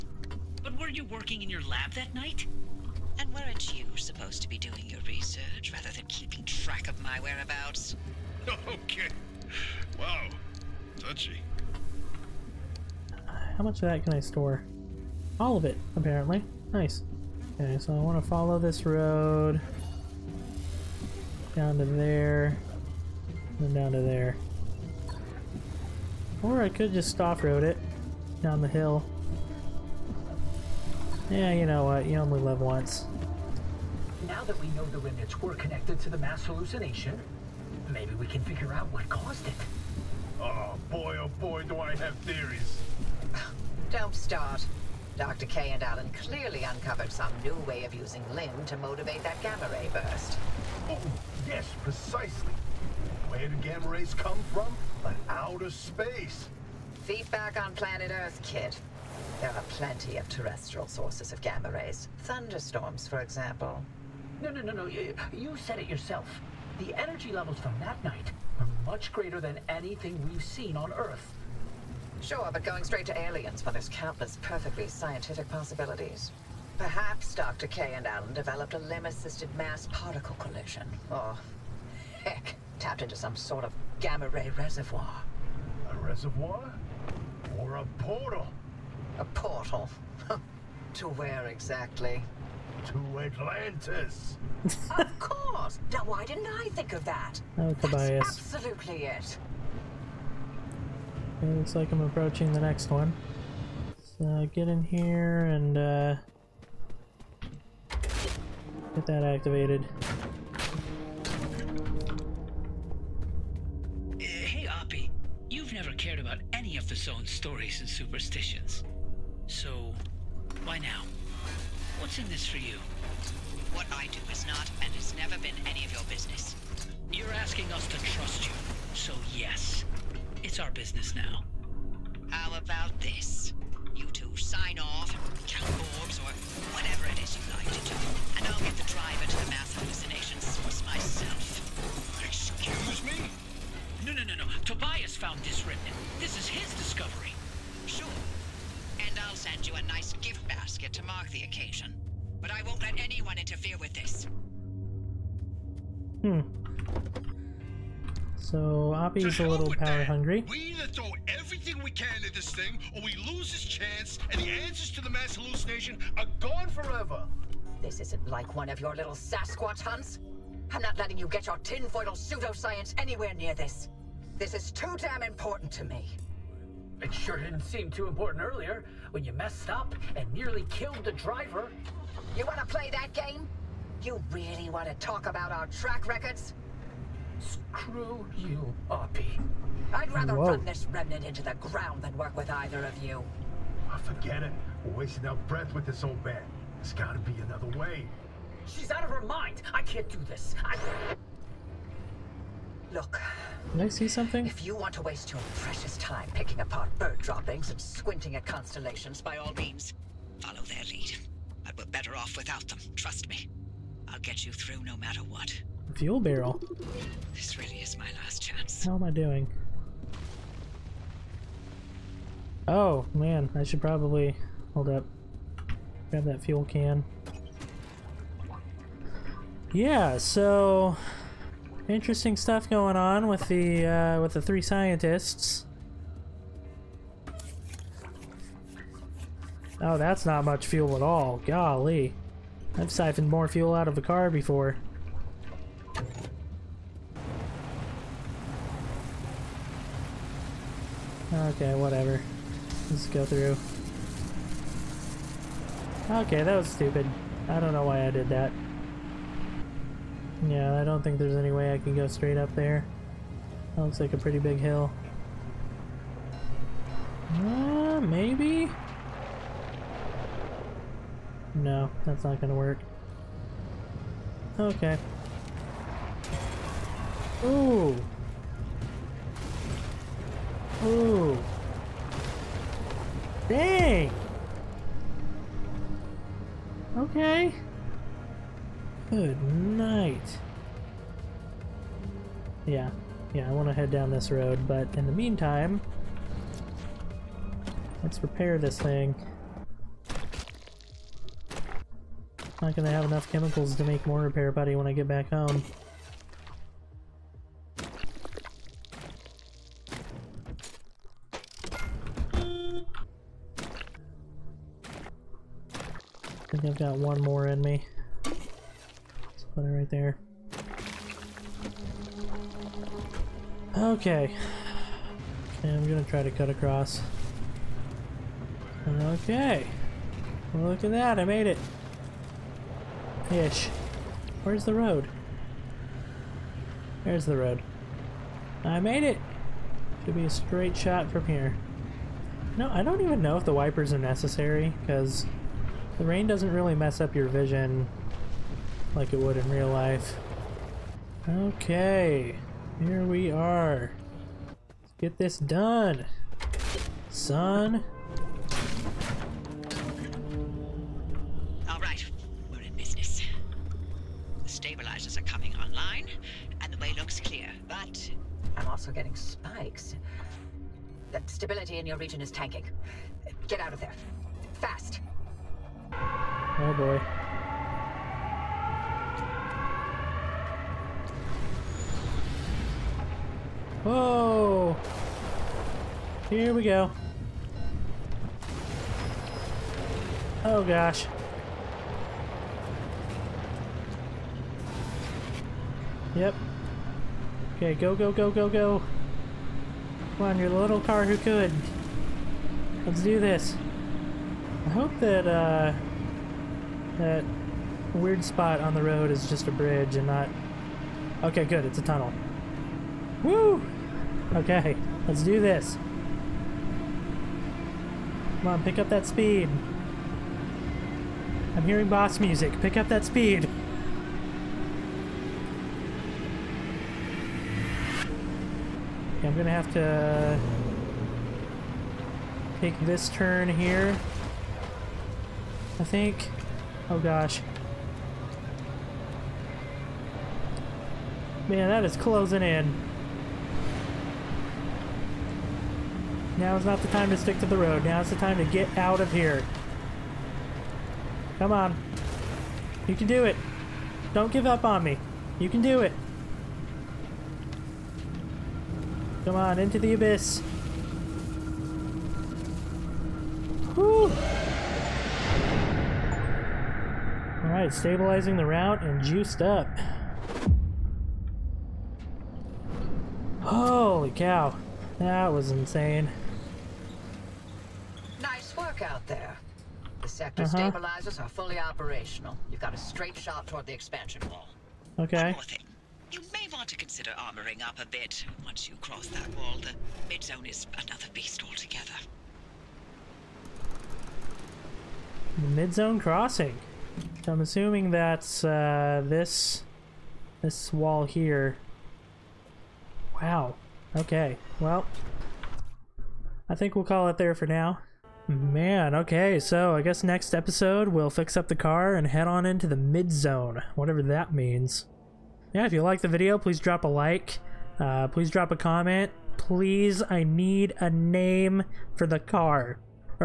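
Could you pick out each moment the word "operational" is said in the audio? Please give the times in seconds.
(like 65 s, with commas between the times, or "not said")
481 s.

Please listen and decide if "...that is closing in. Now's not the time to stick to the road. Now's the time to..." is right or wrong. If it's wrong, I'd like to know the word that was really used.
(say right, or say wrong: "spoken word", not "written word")
right.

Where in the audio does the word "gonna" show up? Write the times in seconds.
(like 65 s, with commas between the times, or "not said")
272 s, 302 s, 325 s, 429 s.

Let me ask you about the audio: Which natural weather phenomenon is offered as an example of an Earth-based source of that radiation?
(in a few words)
Thunderstorms.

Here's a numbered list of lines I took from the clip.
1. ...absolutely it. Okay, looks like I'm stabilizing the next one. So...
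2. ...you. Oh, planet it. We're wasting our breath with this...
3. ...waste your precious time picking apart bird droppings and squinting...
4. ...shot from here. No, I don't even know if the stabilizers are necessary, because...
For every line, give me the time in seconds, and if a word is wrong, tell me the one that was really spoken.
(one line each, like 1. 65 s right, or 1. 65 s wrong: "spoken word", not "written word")
1. 98 s wrong: "approaching", not "stabilizing"
2. 193 s wrong: "forget", not "planet"
3. 205 s right
4. 340 s wrong: "wipers", not "stabilizers".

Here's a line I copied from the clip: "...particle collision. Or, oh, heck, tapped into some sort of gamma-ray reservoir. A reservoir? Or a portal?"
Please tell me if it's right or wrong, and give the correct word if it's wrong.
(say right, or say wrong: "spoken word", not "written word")
right.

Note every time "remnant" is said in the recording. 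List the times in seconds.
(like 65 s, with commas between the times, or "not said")
34 s, 145 s, 190 s.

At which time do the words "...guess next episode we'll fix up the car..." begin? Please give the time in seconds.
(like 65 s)
509 s.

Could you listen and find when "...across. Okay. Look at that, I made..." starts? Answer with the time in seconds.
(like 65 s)
326 s.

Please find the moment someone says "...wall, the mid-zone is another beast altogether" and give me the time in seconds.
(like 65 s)
489 s.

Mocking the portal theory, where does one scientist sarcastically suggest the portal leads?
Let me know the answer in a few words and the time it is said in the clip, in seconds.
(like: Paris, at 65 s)
Atlantis, at 93 s.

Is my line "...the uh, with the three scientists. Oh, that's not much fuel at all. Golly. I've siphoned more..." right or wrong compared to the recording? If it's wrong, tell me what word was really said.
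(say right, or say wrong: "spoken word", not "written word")
right.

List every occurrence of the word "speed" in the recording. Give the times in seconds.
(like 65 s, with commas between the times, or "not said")
419 s, 423 s.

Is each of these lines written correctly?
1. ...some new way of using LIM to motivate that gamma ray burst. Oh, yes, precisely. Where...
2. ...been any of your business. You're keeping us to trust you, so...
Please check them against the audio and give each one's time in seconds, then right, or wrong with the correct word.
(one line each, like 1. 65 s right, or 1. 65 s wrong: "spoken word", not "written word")
1. 47 s right
2. 125 s wrong: "asking", not "keeping".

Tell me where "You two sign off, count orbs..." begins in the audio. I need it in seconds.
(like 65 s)
133 s.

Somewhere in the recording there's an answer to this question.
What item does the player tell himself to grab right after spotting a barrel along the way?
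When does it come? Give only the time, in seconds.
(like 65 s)
226 s.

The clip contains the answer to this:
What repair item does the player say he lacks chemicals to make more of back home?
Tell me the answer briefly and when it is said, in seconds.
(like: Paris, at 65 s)
Repair putty, at 304 s.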